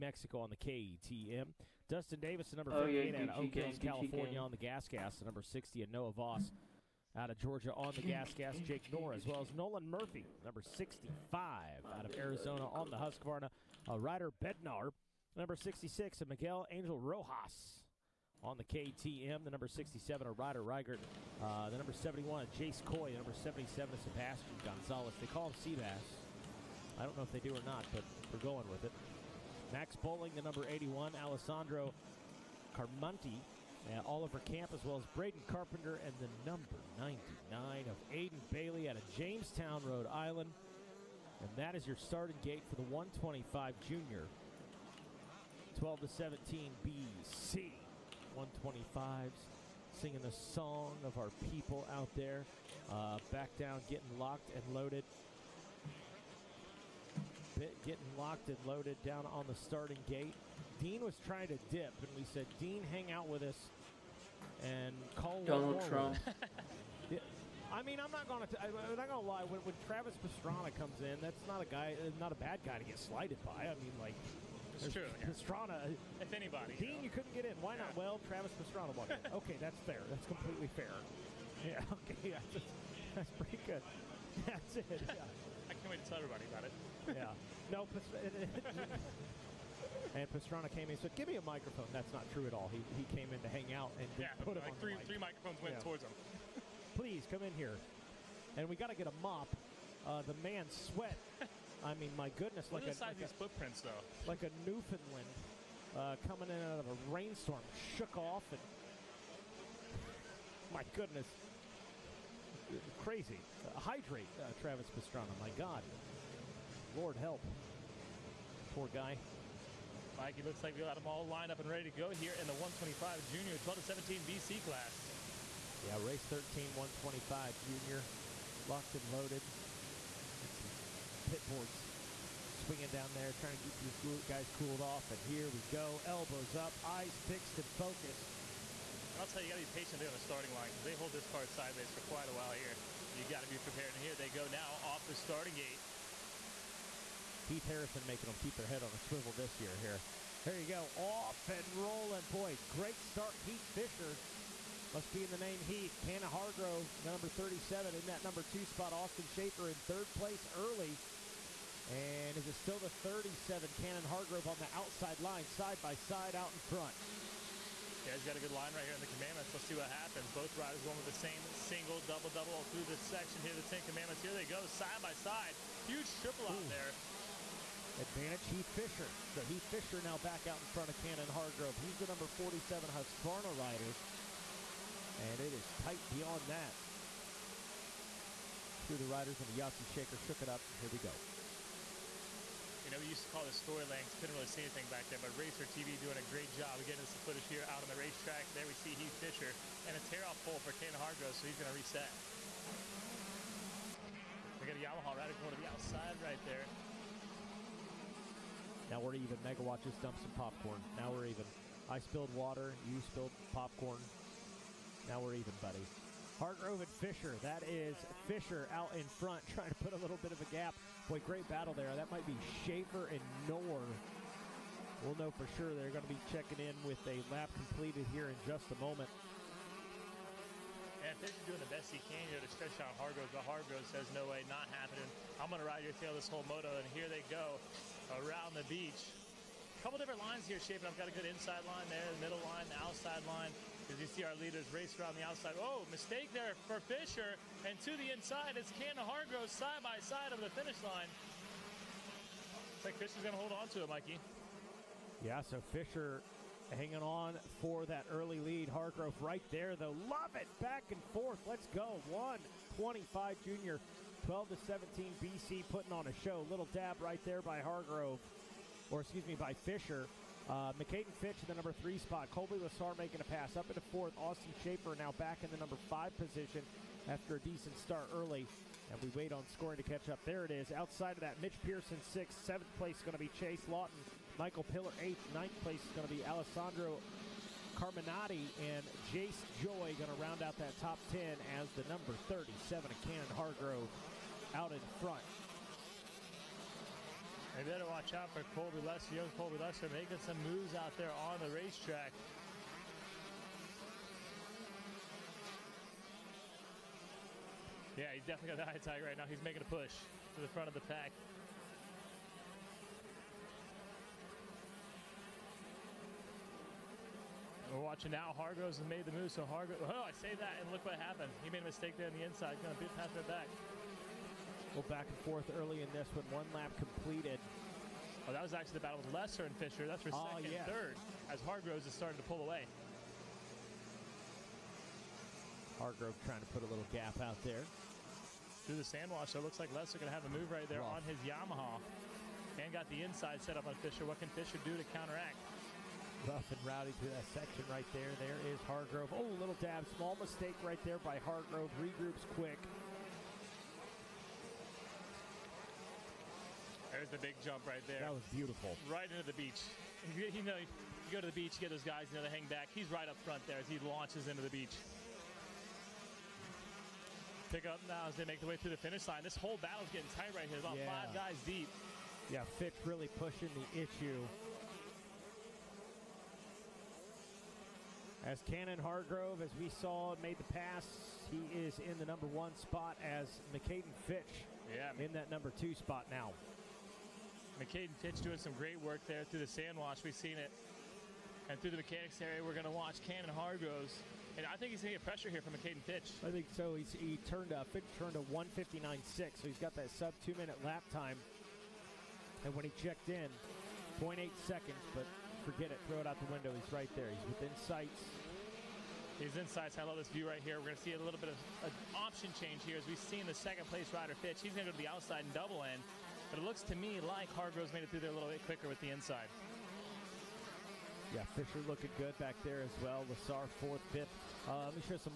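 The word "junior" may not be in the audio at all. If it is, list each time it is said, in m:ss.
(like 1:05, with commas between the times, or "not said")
0:43, 2:03, 2:07, 4:23.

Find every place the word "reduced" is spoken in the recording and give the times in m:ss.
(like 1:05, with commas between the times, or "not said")
not said.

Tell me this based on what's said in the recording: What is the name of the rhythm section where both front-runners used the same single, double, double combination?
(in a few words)
the 10 commandments.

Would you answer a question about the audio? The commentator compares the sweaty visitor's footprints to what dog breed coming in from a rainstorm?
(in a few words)
Newfoundland.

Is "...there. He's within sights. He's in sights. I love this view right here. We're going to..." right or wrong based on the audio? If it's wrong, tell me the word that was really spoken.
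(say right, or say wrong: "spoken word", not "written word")
right.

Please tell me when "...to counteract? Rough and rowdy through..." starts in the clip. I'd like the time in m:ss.
5:44.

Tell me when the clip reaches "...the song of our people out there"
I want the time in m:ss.
0:50.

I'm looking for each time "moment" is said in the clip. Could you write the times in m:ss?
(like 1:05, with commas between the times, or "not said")
3:48.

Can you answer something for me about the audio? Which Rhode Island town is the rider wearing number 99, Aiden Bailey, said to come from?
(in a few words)
Jamestown.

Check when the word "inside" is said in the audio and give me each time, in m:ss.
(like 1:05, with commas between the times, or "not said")
4:01, 4:08, 5:22, 5:43, 6:58.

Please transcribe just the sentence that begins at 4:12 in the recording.
Looks like Fisher's going to hold on to it, Mikey.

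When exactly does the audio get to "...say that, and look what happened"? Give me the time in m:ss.
5:20.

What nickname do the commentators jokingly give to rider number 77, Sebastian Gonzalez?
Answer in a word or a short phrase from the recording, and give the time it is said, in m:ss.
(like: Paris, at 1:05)
Seabass, at 0:25.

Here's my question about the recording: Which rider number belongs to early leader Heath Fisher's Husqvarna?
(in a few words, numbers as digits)
47.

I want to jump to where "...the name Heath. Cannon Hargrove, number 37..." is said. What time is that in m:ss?
2:35.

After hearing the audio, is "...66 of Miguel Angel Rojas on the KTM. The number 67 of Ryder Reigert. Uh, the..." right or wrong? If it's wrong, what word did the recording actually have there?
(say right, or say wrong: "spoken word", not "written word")
right.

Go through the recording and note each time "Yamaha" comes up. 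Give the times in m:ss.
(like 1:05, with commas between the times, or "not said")
3:24, 5:41.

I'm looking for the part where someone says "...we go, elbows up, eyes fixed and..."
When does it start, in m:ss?
2:15.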